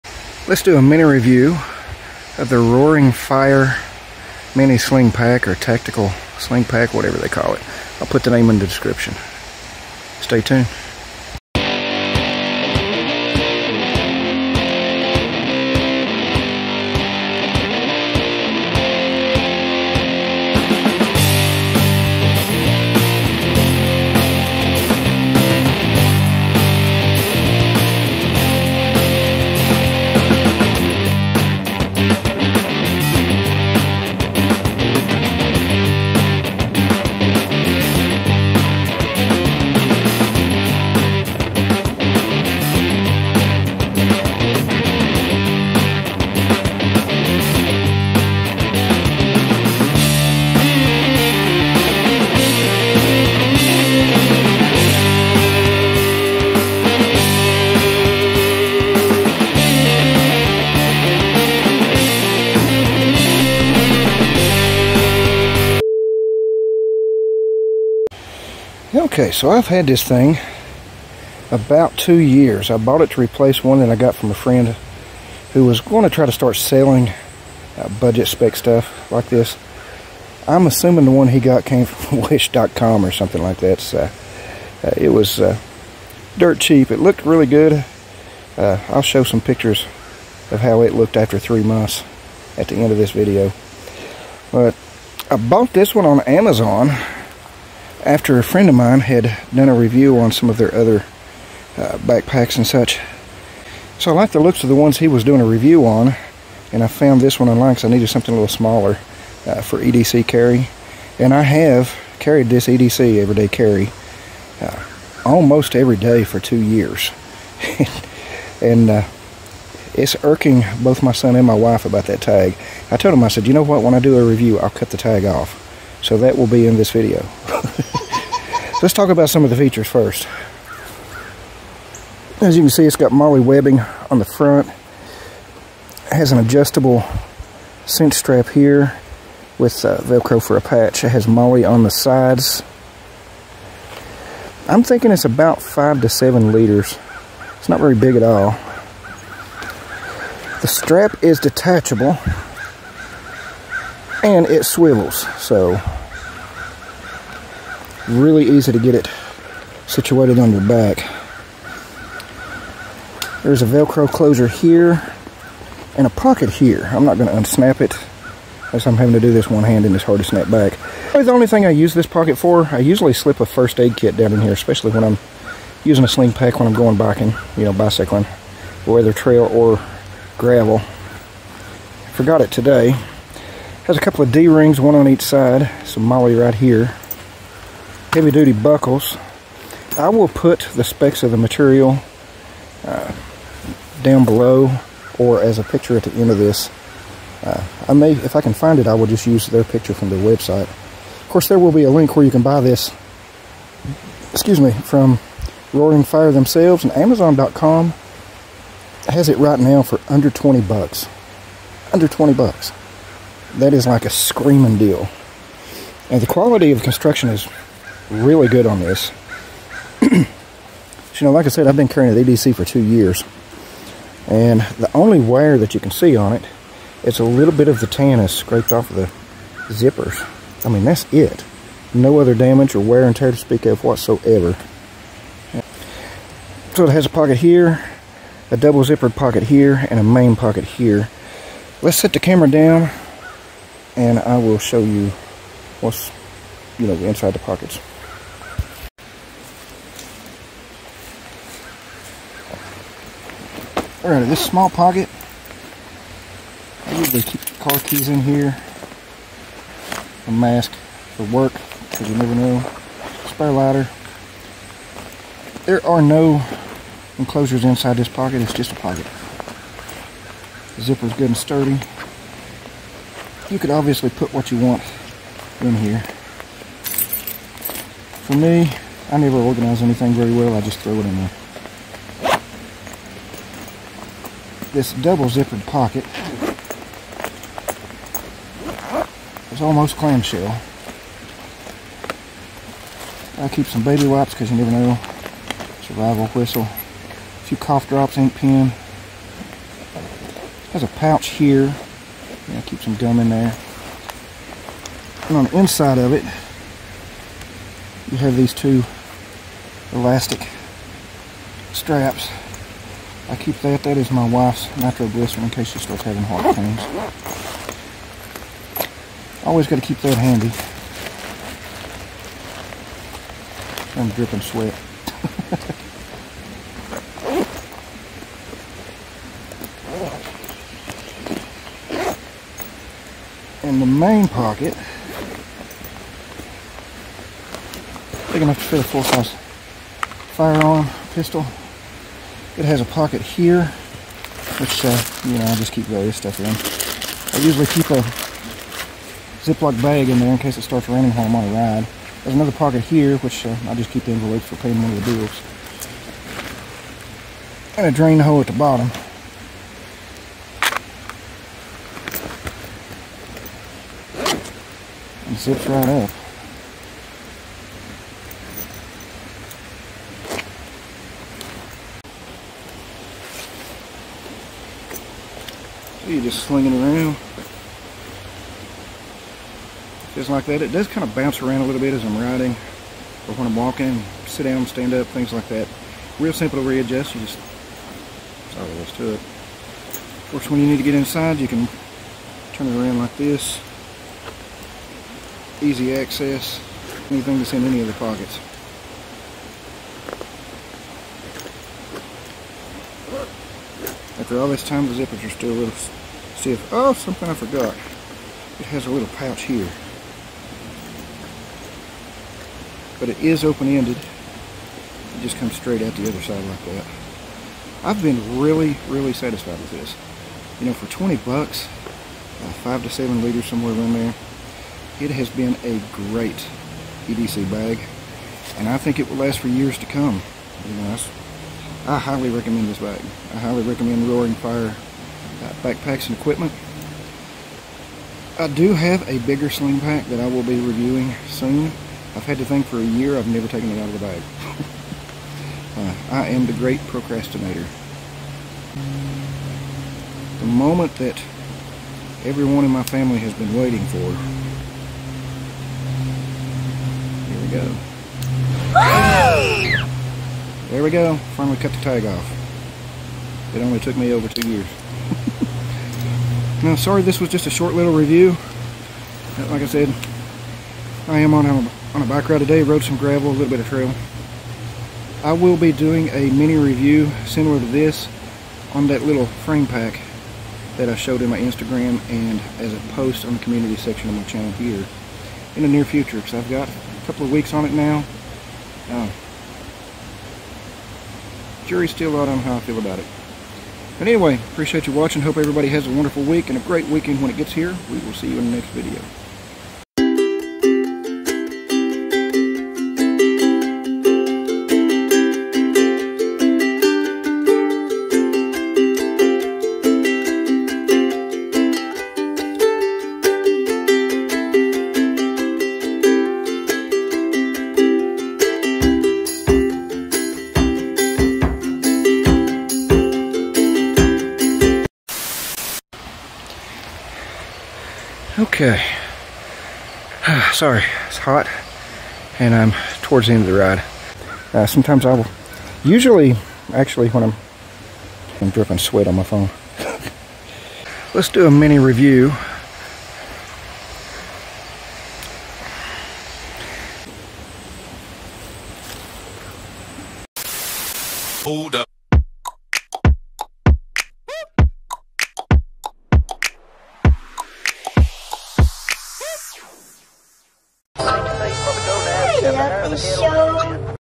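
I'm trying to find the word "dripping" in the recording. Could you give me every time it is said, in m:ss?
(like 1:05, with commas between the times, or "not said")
5:24, 8:58.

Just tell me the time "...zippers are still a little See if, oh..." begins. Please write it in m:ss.
6:44.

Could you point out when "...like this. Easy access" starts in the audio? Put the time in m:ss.
6:32.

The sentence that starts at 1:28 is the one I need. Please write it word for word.
Uh, I'll show some pictures of how it looked after three months at the end of this video.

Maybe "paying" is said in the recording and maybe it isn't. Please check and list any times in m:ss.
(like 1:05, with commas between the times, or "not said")
5:54.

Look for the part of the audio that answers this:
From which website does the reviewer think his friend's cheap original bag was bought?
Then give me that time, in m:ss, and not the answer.
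1:22.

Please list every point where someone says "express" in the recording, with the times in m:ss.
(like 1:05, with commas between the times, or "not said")
not said.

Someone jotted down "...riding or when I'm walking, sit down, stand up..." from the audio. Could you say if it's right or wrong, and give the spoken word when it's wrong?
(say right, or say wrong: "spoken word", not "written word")
right.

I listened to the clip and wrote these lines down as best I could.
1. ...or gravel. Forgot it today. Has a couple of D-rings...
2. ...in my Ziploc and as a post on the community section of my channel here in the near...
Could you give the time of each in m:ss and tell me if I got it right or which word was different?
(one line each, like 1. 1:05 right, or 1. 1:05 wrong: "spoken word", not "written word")
1. 2:59 right
2. 8:01 wrong: "Instagram", not "Ziploc".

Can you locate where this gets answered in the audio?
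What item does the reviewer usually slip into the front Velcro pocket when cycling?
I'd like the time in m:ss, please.
2:53.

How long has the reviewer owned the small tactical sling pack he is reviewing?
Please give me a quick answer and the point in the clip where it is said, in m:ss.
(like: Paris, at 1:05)
2 years, at 1:11.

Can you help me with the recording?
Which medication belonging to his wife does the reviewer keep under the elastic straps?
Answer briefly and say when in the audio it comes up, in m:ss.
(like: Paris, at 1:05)
nitroglycerin, at 5:14.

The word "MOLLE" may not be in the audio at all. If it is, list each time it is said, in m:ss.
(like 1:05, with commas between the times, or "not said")
2:13, 2:21, 3:06.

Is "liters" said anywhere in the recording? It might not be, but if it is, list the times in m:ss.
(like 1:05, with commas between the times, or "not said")
2:26, 7:03.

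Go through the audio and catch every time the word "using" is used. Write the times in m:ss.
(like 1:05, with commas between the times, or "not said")
2:55.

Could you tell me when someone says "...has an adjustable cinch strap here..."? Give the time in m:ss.
2:16.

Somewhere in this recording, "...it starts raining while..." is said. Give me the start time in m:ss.
5:50.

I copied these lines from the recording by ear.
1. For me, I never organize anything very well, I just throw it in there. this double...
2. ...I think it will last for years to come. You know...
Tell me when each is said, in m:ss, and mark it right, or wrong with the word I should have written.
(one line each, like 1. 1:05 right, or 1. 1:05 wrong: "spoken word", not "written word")
1. 4:38 right
2. 7:08 right.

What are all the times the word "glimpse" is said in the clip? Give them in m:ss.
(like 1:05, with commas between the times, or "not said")
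not said.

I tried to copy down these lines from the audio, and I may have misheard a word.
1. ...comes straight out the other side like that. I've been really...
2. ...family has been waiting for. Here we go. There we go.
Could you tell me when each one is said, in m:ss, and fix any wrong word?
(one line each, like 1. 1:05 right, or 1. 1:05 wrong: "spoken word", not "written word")
1. 6:55 right
2. 7:32 right.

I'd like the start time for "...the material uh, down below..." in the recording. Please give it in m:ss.
3:11.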